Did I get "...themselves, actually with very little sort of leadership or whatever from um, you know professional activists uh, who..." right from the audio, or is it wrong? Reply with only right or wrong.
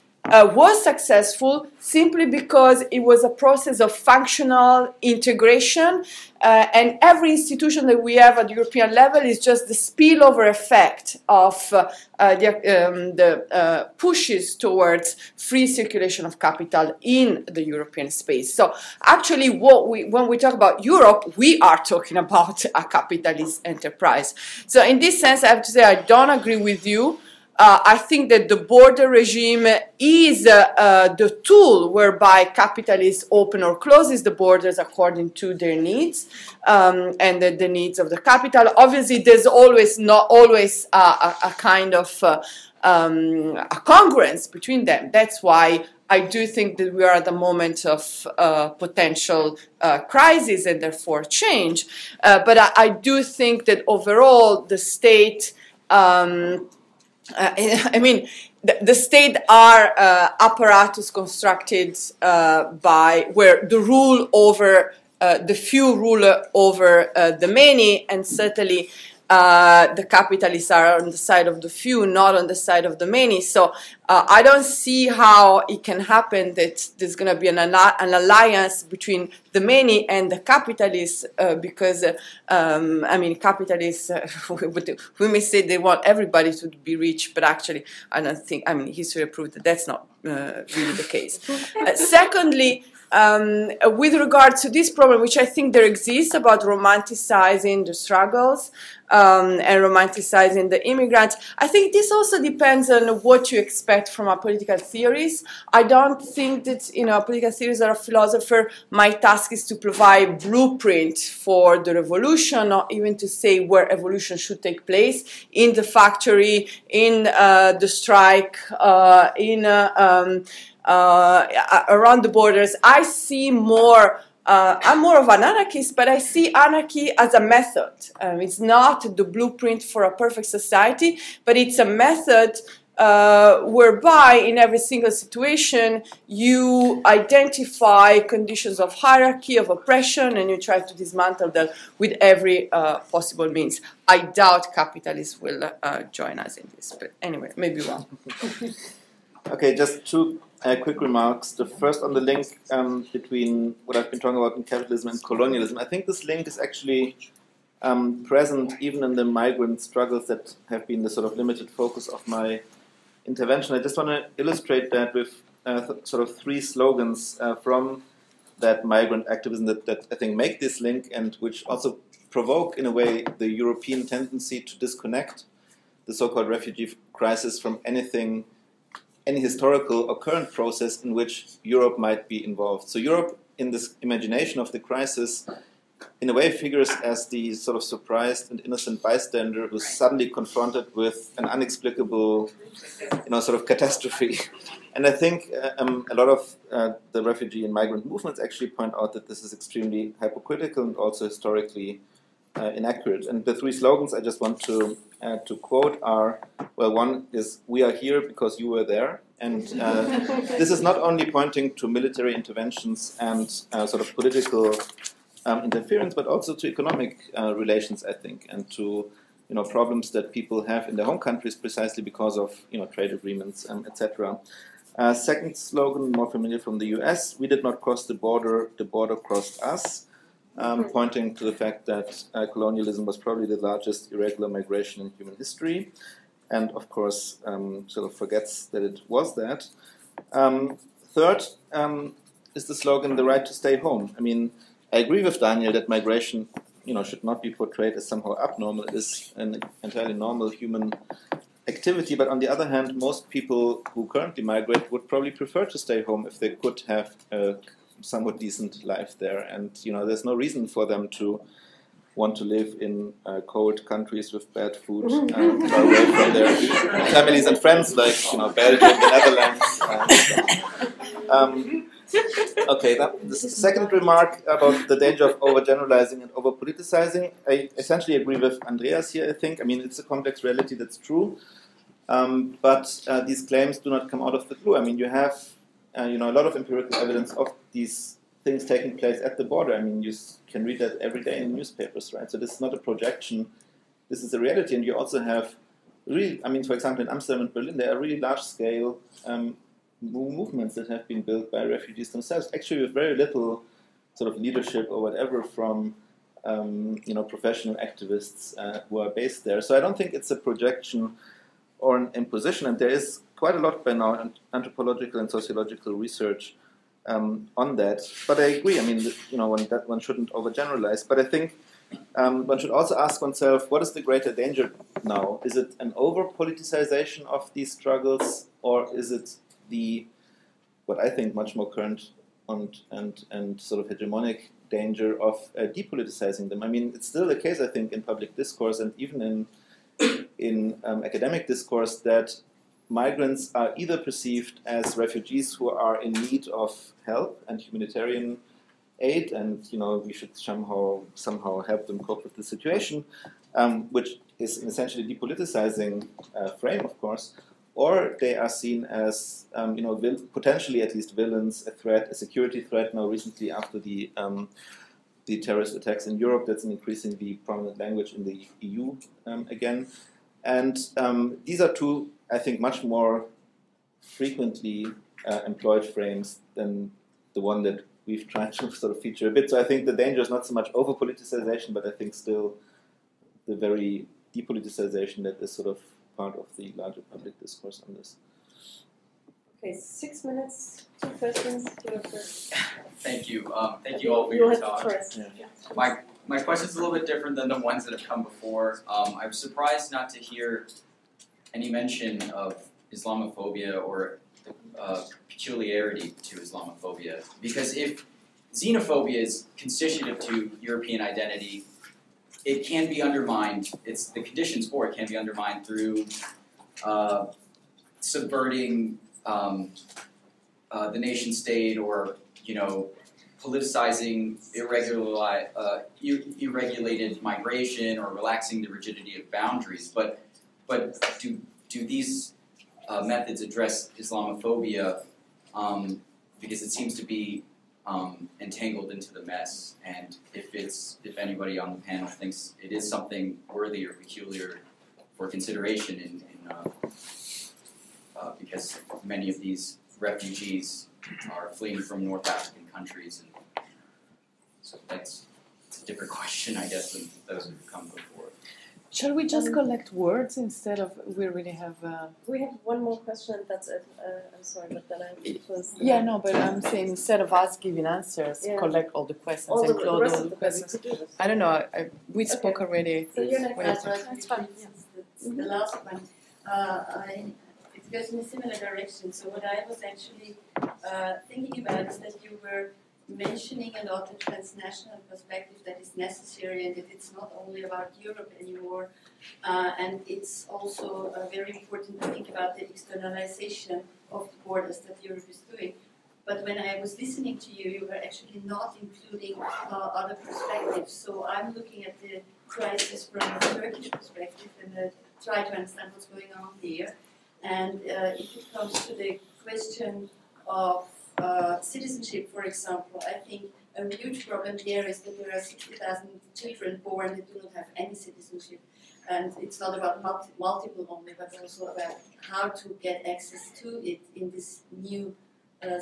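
right.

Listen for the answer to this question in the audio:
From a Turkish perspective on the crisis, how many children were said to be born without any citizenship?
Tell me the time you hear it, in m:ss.
8:35.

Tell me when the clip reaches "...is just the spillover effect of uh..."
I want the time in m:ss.
0:09.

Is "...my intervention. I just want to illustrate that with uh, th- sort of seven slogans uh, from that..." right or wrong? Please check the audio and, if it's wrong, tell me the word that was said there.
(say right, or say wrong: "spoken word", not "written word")
wrong: "three", not "seven".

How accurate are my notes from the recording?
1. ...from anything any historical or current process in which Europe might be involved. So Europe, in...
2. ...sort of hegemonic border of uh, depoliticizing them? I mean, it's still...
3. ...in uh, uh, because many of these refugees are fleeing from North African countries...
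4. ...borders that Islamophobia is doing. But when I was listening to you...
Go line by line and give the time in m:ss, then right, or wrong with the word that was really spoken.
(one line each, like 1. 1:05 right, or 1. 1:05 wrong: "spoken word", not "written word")
1. 2:57 right
2. 5:33 wrong: "danger", not "border"
3. 7:26 right
4. 8:14 wrong: "Europe", not "Islamophobia".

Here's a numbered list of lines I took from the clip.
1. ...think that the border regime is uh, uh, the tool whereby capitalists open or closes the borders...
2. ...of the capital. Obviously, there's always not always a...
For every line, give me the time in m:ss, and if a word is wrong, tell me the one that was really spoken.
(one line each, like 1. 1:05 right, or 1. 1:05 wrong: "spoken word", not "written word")
1. 0:27 right
2. 0:37 right.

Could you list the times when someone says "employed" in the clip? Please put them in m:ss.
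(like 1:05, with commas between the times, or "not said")
6:15.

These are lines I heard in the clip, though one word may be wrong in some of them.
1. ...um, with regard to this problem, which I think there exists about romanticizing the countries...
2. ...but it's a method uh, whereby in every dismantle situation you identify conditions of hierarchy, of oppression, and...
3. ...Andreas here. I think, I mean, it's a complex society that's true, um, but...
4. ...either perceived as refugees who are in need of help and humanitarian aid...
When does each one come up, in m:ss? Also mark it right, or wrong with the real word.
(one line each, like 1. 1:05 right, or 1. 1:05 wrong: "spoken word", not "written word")
1. 1:33 wrong: "struggles", not "countries"
2. 2:11 wrong: "single", not "dismantle"
3. 4:38 wrong: "reality", not "society"
4. 5:43 right.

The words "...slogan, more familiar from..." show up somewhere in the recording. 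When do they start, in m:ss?
3:45.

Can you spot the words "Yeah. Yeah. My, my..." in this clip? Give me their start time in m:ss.
6:34.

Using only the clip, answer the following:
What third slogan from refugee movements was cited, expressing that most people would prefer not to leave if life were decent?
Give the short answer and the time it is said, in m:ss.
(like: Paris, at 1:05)
the right to stay home, at 4:03.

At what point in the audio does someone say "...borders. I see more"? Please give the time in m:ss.
2:02.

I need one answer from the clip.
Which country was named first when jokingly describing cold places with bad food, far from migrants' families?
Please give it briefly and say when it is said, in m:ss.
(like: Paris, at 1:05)
Belgium, at 4:28.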